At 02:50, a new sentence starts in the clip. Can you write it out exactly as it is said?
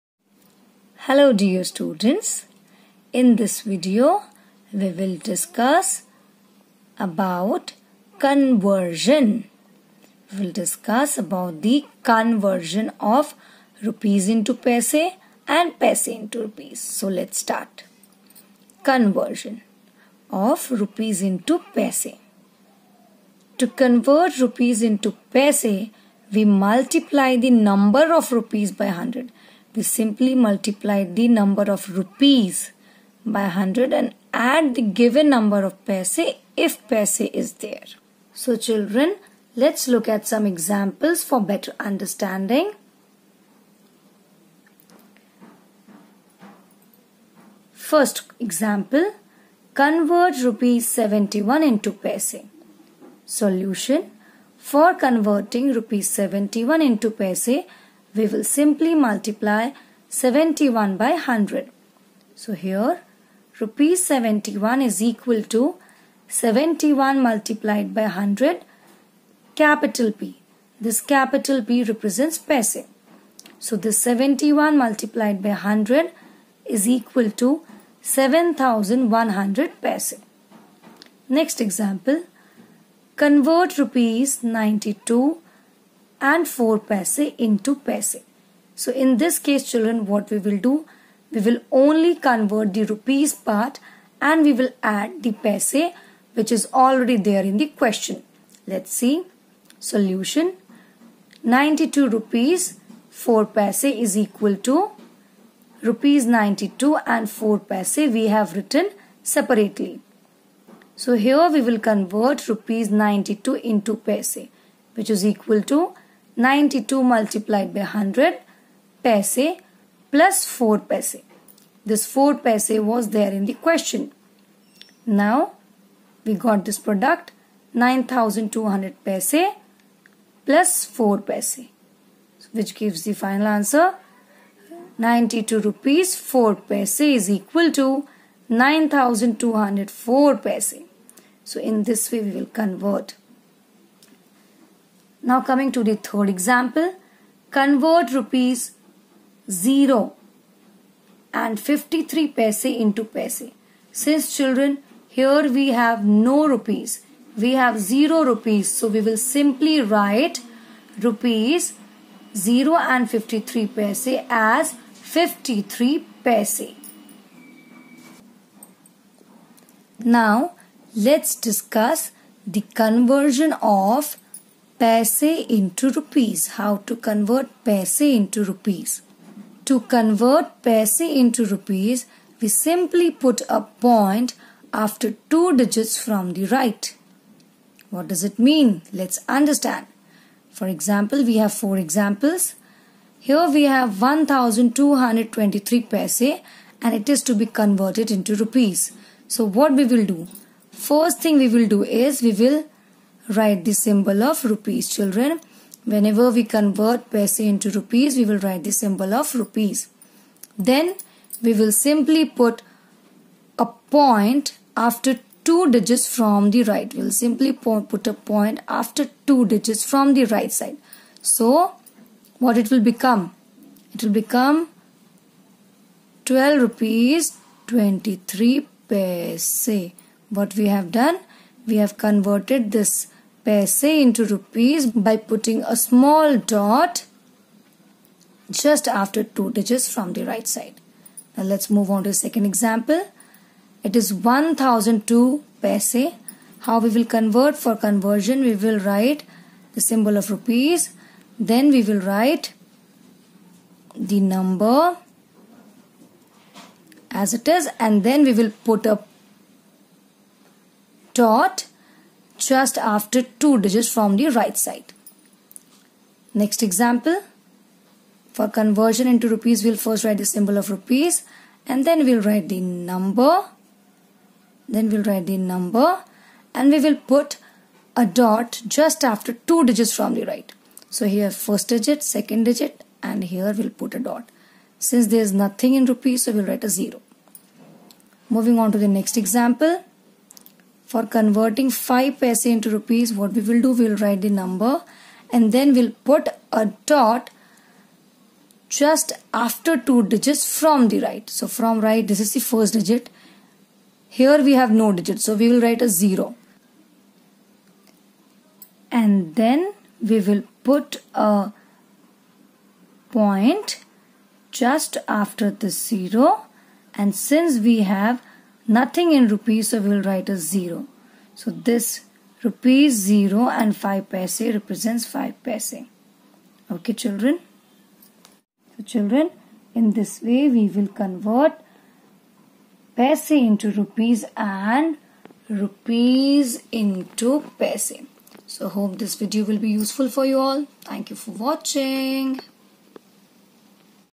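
Now let's discuss the conversion of paise into rupees.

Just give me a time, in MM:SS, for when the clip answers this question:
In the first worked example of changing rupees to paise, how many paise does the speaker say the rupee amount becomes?
01:18.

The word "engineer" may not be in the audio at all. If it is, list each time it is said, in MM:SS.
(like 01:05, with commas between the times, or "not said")
not said.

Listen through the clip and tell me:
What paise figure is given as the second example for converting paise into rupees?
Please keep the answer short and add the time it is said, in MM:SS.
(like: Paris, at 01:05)
1002 paise, at 04:04.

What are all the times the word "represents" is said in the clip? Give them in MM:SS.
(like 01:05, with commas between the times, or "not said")
01:11, 05:24.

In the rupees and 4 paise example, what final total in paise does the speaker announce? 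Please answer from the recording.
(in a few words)
9204 paise.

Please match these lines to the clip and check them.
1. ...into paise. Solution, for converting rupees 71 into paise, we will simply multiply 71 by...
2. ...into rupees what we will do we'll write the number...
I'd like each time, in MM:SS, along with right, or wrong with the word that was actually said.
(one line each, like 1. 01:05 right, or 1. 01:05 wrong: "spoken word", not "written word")
1. 00:51 right
2. 04:52 right.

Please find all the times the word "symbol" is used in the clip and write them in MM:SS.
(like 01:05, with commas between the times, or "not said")
03:23, 03:28, 04:09, 04:30.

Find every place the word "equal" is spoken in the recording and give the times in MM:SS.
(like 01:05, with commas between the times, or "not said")
01:05, 01:16, 01:44, 01:55, 02:17.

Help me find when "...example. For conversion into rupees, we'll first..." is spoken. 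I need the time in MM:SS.
04:26.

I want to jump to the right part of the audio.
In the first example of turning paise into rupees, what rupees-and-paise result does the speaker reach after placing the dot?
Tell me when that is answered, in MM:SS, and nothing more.
03:46.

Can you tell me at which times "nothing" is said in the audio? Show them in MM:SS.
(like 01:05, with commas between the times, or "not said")
04:45, 05:18.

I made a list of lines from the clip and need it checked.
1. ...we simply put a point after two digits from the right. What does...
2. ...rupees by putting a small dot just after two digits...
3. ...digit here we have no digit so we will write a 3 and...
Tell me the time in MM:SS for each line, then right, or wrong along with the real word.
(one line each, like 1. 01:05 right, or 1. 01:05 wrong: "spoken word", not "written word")
1. 03:02 right
2. 03:54 right
3. 05:02 wrong: "0", not "3".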